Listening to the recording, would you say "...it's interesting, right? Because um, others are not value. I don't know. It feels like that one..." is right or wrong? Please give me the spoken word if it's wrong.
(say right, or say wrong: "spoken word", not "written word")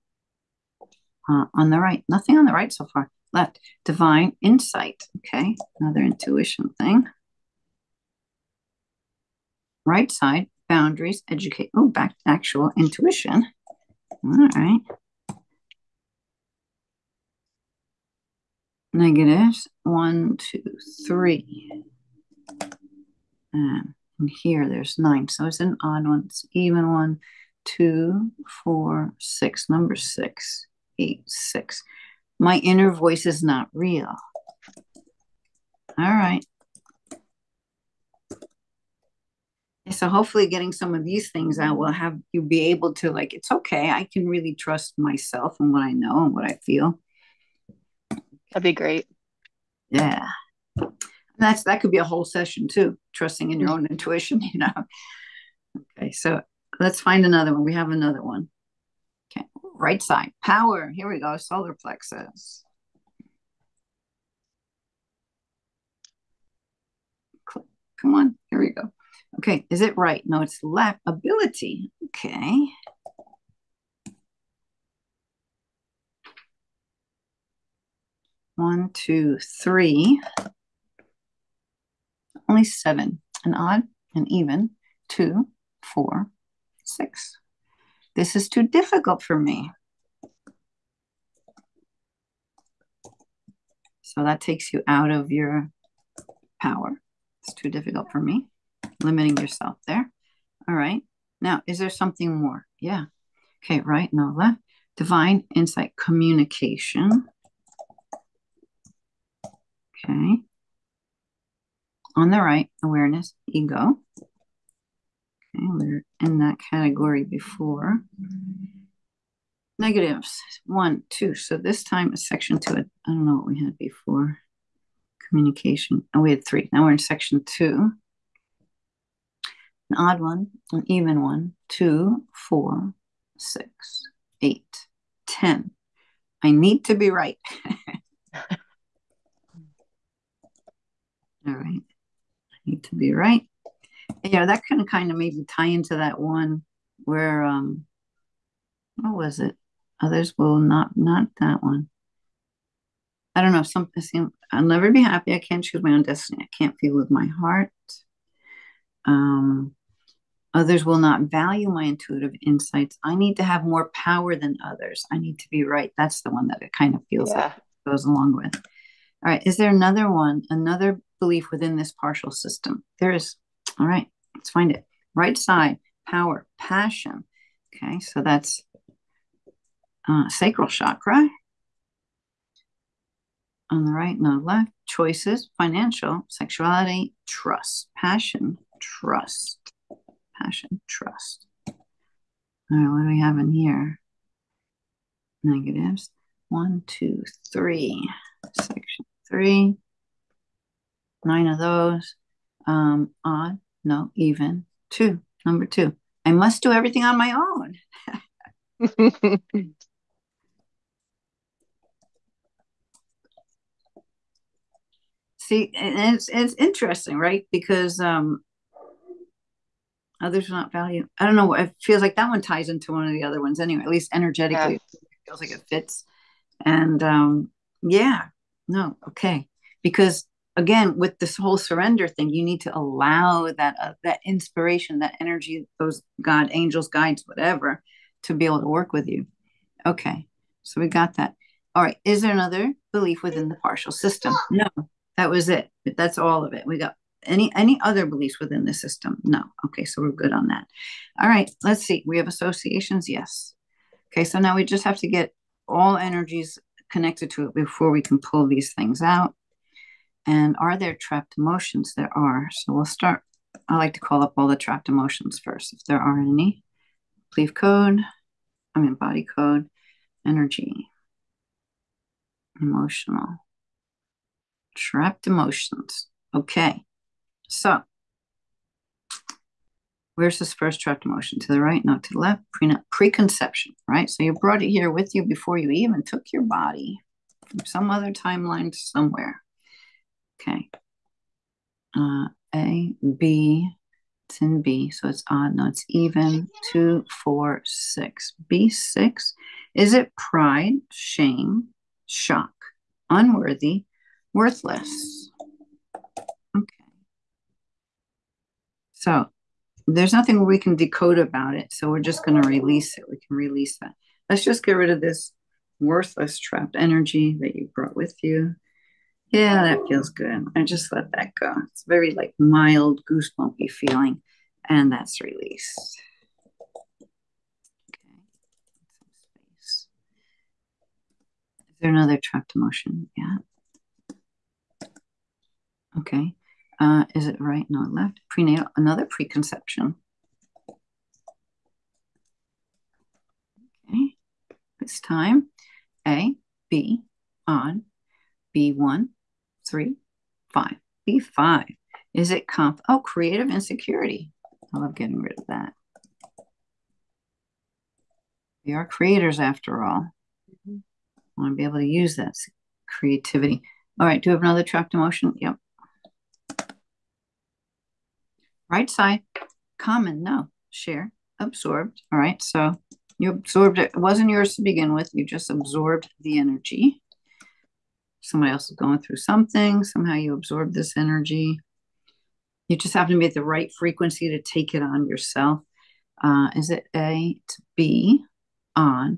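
right.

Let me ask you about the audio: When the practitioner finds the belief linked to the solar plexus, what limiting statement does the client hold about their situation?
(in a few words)
This is too difficult for me.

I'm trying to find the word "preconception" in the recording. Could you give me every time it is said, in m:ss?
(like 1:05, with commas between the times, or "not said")
4:42, 5:39.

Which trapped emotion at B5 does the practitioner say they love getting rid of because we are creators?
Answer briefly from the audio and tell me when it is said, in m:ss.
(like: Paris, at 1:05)
Creative insecurity, at 5:52.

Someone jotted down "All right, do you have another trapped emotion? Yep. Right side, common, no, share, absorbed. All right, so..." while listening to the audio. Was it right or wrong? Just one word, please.
right.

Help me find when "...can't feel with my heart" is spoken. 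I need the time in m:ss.
2:36.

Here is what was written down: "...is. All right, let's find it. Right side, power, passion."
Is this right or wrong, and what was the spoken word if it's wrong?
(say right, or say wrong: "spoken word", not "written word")
right.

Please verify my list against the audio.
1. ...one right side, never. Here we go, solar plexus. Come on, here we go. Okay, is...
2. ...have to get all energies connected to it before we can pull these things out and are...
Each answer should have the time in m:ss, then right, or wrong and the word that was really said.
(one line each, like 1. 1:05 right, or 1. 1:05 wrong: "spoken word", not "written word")
1. 0:58 wrong: "power", not "never"
2. 4:14 right.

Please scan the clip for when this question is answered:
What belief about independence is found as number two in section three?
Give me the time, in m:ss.
3:26.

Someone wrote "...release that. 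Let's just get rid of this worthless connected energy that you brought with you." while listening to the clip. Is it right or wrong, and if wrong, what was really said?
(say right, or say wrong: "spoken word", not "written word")
wrong: "trapped", not "connected".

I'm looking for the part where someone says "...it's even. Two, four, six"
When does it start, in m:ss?
4:55.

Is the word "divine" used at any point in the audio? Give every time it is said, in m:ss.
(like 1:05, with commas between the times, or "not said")
0:03, 1:44.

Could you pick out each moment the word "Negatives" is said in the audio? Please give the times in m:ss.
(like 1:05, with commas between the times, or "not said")
0:18, 1:59, 3:15.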